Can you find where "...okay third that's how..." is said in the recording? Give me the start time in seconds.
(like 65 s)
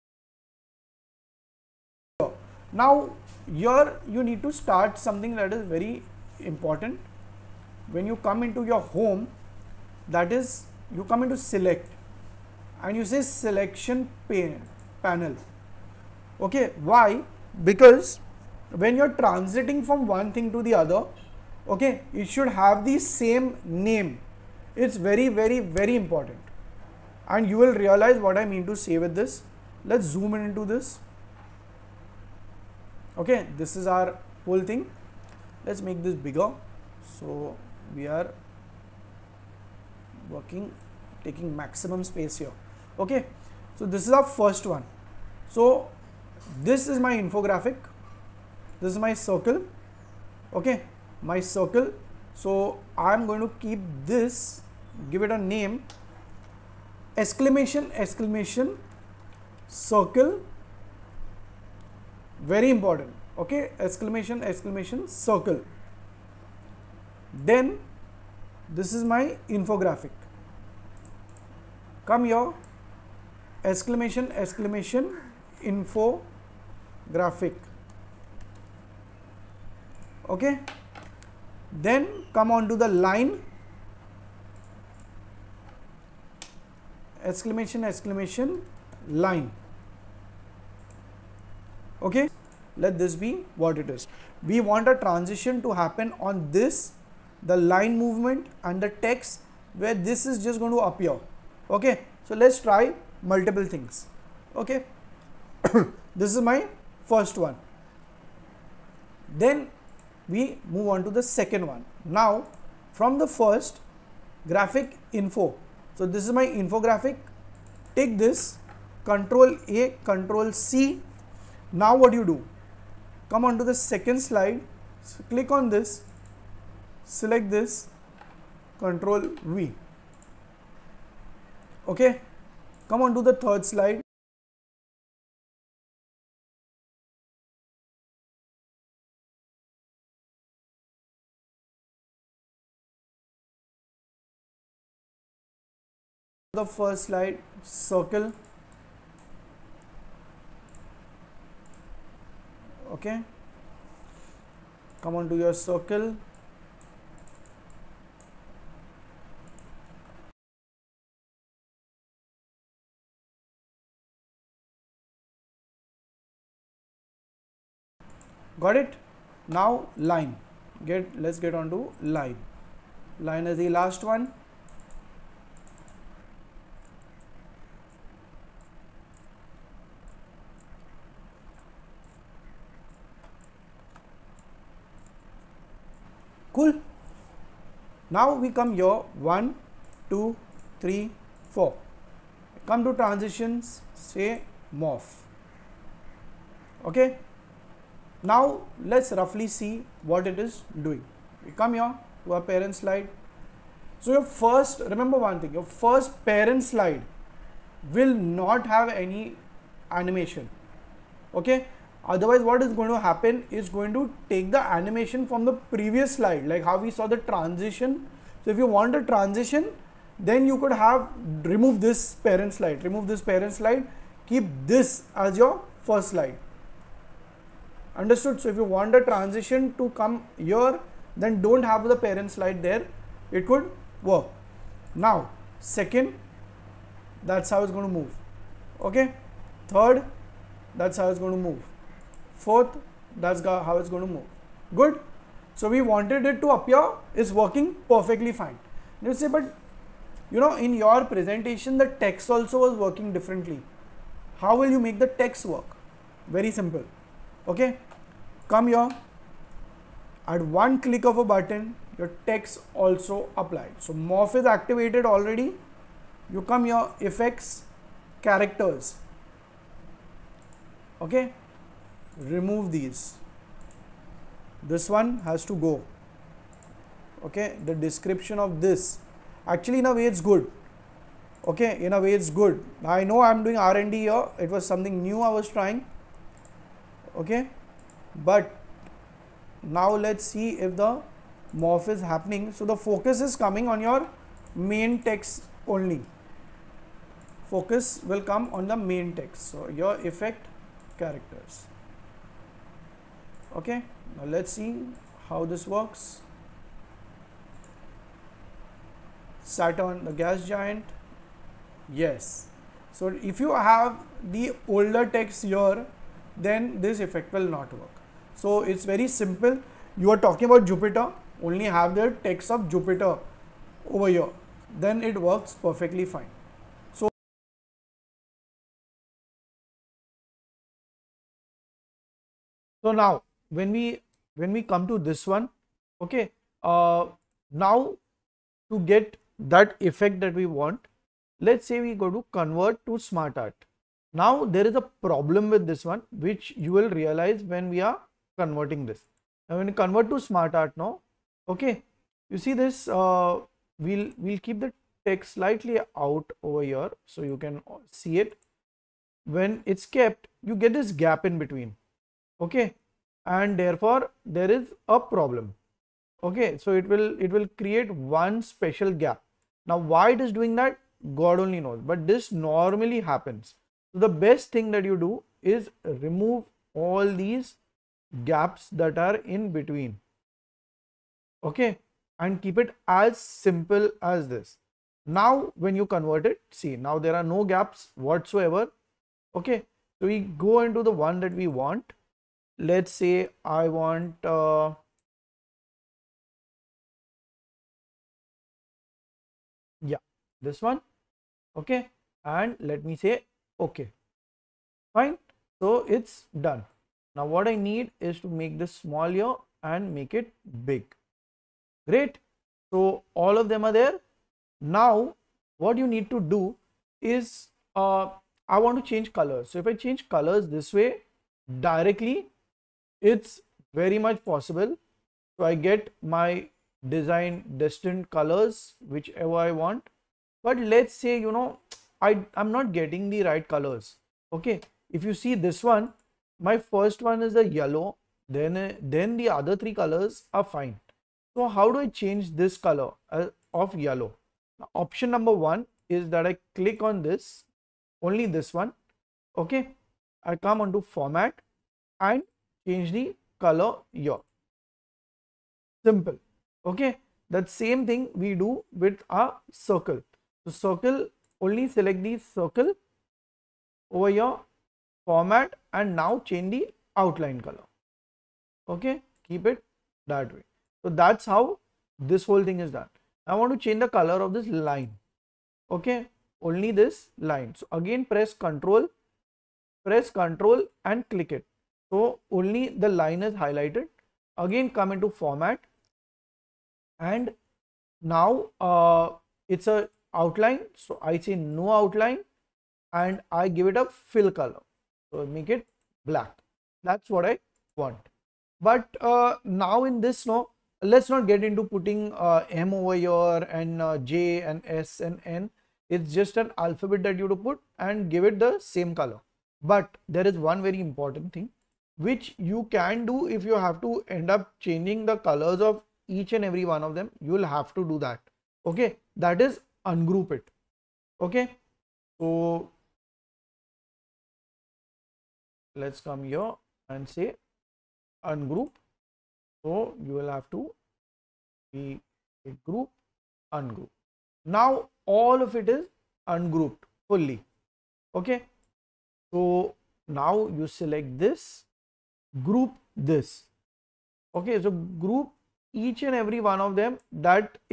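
238 s.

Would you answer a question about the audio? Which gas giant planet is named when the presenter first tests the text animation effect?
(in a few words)
Saturn.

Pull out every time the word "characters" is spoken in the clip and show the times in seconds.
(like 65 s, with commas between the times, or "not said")
268 s, 300 s.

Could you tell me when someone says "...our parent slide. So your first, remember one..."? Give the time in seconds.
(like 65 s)
202 s.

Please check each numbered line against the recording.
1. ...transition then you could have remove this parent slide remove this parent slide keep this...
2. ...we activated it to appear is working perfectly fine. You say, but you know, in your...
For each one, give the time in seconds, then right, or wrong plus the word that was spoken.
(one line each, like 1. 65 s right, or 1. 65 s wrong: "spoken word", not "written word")
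1. 219 s right
2. 245 s wrong: "wanted", not "activated".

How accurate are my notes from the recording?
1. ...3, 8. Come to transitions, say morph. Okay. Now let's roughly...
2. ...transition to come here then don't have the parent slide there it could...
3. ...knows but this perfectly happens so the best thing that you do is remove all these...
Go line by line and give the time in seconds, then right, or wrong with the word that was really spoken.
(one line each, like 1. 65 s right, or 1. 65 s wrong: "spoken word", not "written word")
1. 190 s wrong: "4", not "8"
2. 229 s right
3. 371 s wrong: "normally", not "perfectly".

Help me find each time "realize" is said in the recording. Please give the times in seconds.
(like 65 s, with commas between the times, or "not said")
27 s, 346 s.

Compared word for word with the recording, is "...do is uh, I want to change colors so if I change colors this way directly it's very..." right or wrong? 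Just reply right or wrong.
right.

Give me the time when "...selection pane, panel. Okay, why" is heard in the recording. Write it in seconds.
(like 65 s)
13 s.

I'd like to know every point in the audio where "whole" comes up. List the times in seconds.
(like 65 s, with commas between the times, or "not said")
34 s, 472 s.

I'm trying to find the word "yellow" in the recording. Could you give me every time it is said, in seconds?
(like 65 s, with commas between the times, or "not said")
437 s, 443 s.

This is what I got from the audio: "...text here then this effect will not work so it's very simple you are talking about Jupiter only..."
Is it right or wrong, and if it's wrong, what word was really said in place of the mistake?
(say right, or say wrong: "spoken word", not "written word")
right.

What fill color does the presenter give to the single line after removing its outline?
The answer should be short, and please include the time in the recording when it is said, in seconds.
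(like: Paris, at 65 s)
Black, at 496 s.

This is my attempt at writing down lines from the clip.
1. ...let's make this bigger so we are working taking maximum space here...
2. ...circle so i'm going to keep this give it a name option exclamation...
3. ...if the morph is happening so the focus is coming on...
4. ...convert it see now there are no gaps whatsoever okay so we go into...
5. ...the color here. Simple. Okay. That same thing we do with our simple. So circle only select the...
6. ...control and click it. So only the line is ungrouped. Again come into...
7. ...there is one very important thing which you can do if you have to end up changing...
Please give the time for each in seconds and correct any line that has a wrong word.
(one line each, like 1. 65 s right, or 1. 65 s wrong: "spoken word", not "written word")
1. 35 s right
2. 51 s wrong: "exclamation", not "option"
3. 290 s right
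4. 385 s right
5. 452 s wrong: "circle", not "simple"
6. 480 s wrong: "highlighted", not "ungrouped"
7. 510 s right.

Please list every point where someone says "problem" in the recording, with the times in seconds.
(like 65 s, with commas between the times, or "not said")
345 s, 364 s.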